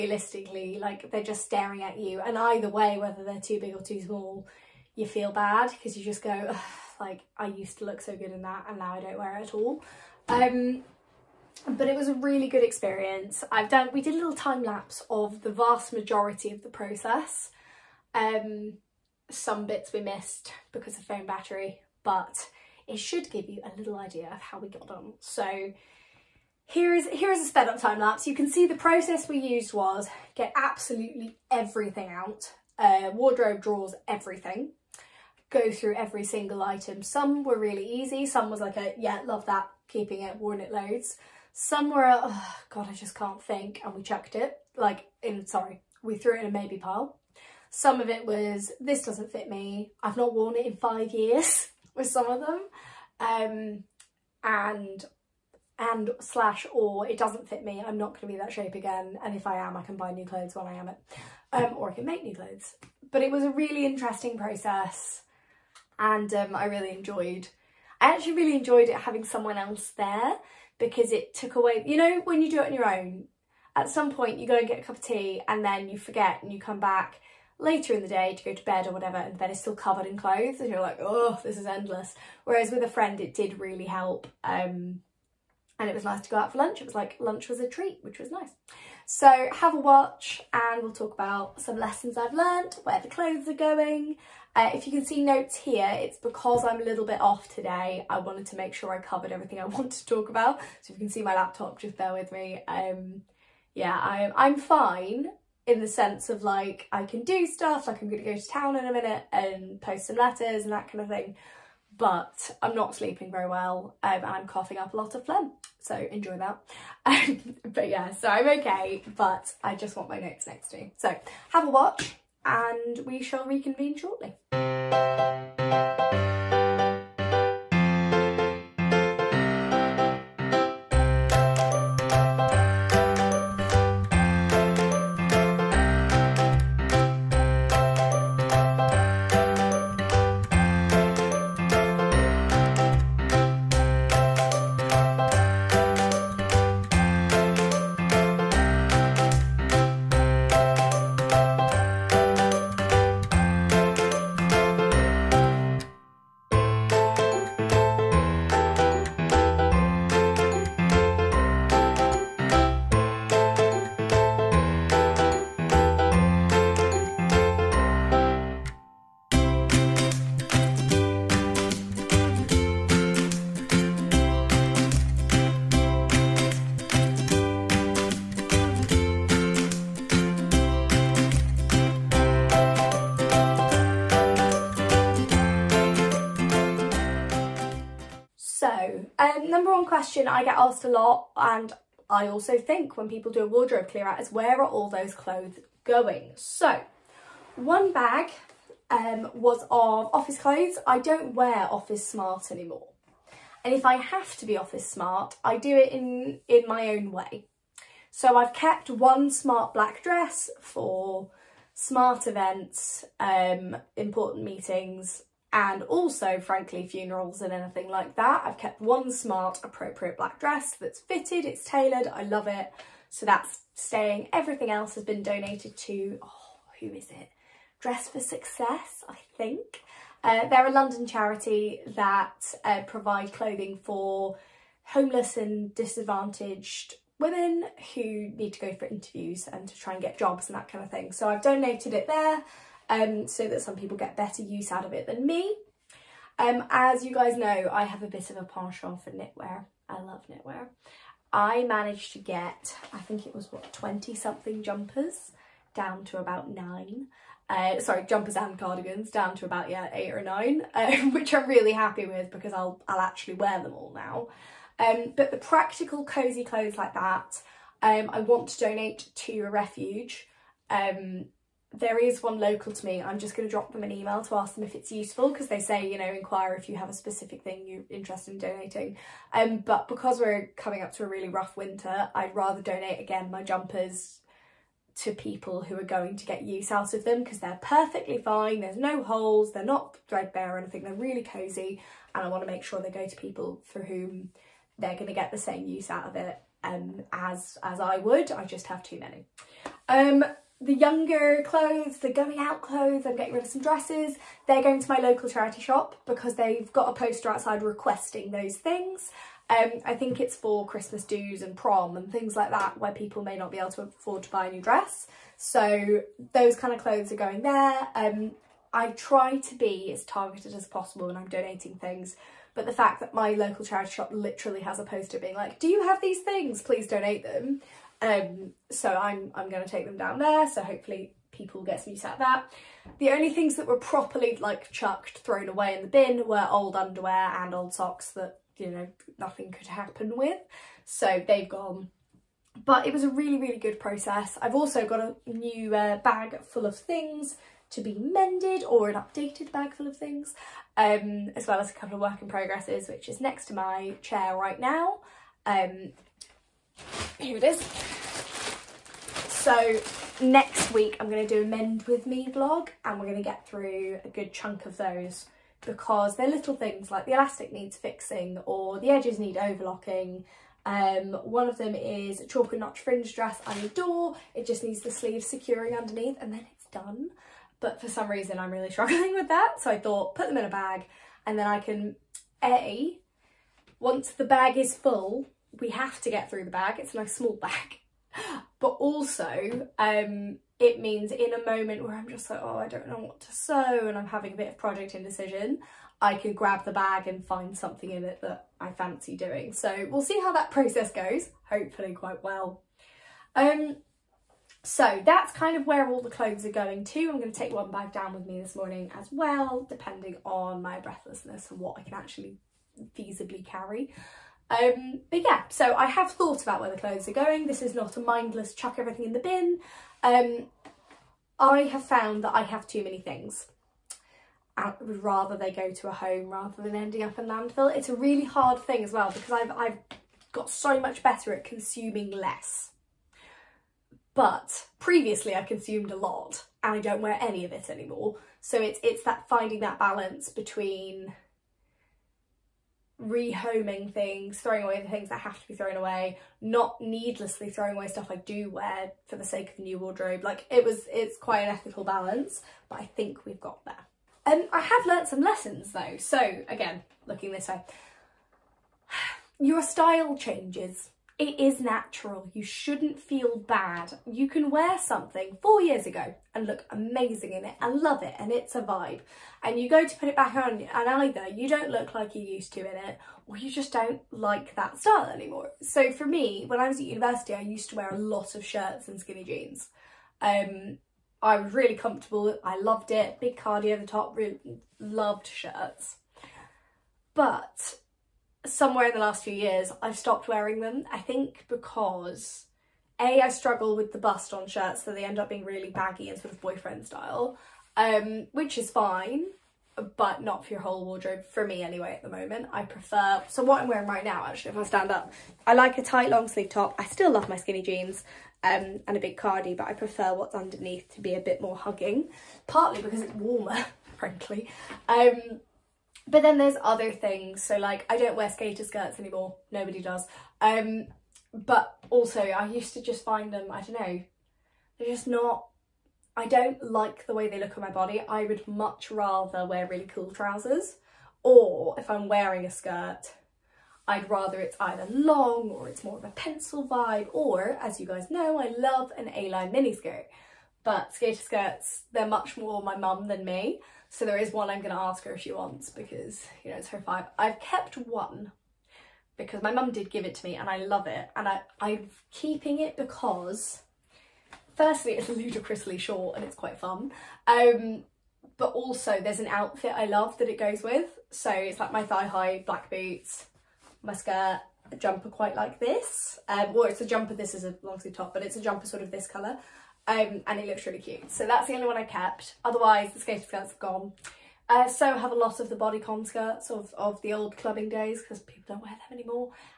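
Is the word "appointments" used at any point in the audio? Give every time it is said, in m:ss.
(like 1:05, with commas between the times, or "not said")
not said.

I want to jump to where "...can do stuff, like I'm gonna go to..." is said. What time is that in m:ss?
1:47.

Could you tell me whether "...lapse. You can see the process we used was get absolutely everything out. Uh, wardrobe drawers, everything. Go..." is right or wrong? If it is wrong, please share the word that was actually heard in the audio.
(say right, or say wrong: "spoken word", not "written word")
right.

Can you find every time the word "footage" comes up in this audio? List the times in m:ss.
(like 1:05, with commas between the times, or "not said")
not said.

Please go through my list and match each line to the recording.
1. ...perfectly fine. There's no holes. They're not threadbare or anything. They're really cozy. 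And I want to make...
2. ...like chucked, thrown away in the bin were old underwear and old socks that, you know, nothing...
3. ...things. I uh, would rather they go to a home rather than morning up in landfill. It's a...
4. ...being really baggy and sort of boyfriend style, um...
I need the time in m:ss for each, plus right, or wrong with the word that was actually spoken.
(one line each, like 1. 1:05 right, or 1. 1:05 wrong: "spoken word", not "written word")
1. 4:47 right
2. 5:34 right
3. 7:03 wrong: "ending", not "morning"
4. 8:15 right.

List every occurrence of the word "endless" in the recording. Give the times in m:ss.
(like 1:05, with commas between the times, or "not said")
1:21.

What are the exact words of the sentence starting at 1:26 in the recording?
It was like lunch was a treat, which was nice.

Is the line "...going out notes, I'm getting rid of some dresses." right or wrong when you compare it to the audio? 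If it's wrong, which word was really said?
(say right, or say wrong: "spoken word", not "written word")
wrong: "clothes", not "notes".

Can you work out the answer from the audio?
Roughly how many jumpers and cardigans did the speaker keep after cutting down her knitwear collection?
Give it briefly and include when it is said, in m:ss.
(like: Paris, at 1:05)
8 or 9, at 4:19.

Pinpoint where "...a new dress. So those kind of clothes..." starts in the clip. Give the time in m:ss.
5:14.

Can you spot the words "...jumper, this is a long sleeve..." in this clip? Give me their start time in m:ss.
9:26.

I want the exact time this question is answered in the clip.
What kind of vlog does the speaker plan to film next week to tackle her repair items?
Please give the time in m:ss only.
6:01.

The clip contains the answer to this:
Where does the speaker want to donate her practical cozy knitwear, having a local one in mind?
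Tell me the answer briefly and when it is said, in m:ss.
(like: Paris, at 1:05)
a refuge, at 4:29.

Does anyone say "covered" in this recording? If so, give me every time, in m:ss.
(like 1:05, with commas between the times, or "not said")
1:19, 1:39.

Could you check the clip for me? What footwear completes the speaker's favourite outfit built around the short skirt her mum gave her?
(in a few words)
thigh-high black boots.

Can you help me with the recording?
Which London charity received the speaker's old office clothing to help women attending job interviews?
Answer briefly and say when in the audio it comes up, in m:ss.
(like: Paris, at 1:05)
Dress for Success, at 3:47.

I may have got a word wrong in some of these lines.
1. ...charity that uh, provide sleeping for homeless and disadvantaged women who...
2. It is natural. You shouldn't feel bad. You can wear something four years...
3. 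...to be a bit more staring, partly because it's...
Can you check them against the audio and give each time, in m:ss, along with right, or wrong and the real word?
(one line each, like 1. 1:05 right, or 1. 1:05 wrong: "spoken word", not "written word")
1. 3:51 wrong: "clothing", not "sleeping"
2. 7:41 right
3. 8:30 wrong: "hugging", not "staring".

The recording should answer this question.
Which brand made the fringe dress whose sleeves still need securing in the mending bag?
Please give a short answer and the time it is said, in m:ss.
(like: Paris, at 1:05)
Chalk and Notch, at 6:12.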